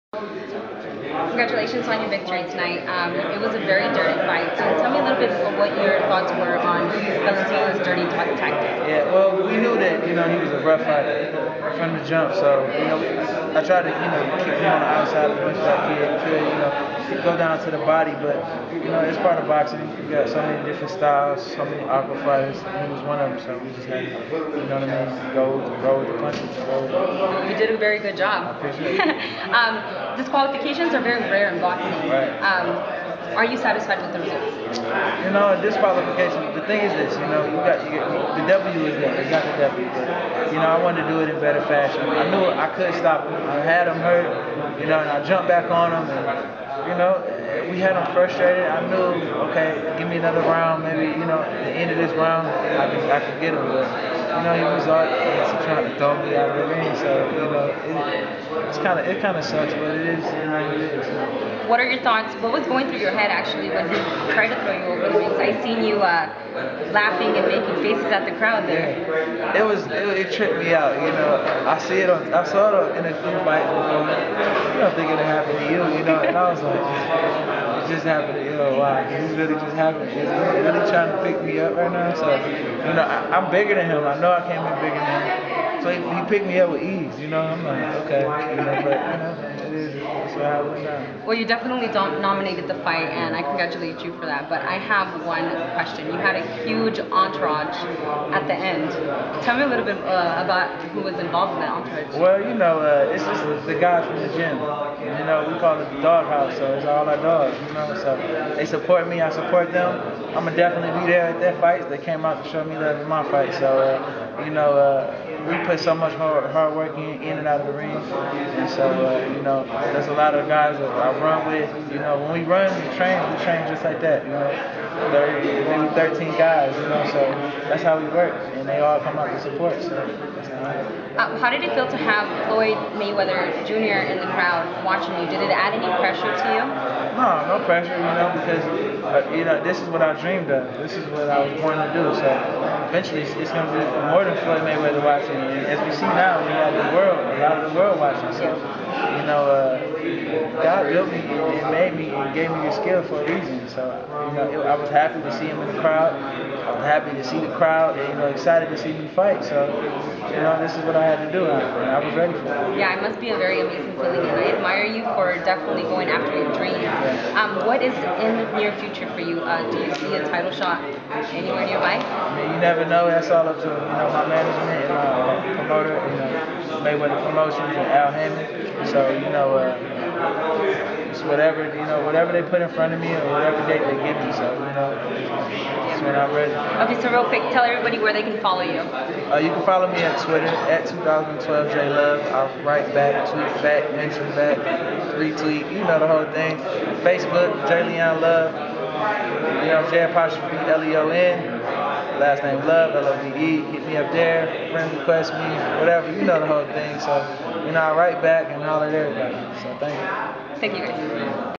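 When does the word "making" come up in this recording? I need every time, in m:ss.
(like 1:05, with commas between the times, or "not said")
1:07.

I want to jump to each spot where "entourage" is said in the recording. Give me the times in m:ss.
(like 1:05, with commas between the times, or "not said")
1:36, 1:41.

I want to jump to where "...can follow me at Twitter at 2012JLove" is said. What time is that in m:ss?
3:09.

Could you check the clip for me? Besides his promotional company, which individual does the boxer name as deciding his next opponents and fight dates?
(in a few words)
Al Haymon.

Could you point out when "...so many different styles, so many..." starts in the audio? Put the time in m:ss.
0:20.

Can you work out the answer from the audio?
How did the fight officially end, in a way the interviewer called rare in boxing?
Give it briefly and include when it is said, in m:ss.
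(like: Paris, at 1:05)
Disqualification, at 0:35.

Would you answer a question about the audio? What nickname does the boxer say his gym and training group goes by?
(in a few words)
The Dog House.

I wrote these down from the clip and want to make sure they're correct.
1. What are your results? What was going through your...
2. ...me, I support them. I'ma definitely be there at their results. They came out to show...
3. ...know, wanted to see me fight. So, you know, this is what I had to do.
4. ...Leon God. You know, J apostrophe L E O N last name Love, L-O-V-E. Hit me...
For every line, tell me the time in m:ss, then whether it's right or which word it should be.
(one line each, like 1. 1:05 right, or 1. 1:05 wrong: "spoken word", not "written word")
1. 1:01 wrong: "thoughts", not "results"
2. 1:49 wrong: "fights", not "results"
3. 2:38 wrong: "excited", not "wanted"
4. 3:17 wrong: "Love", not "God".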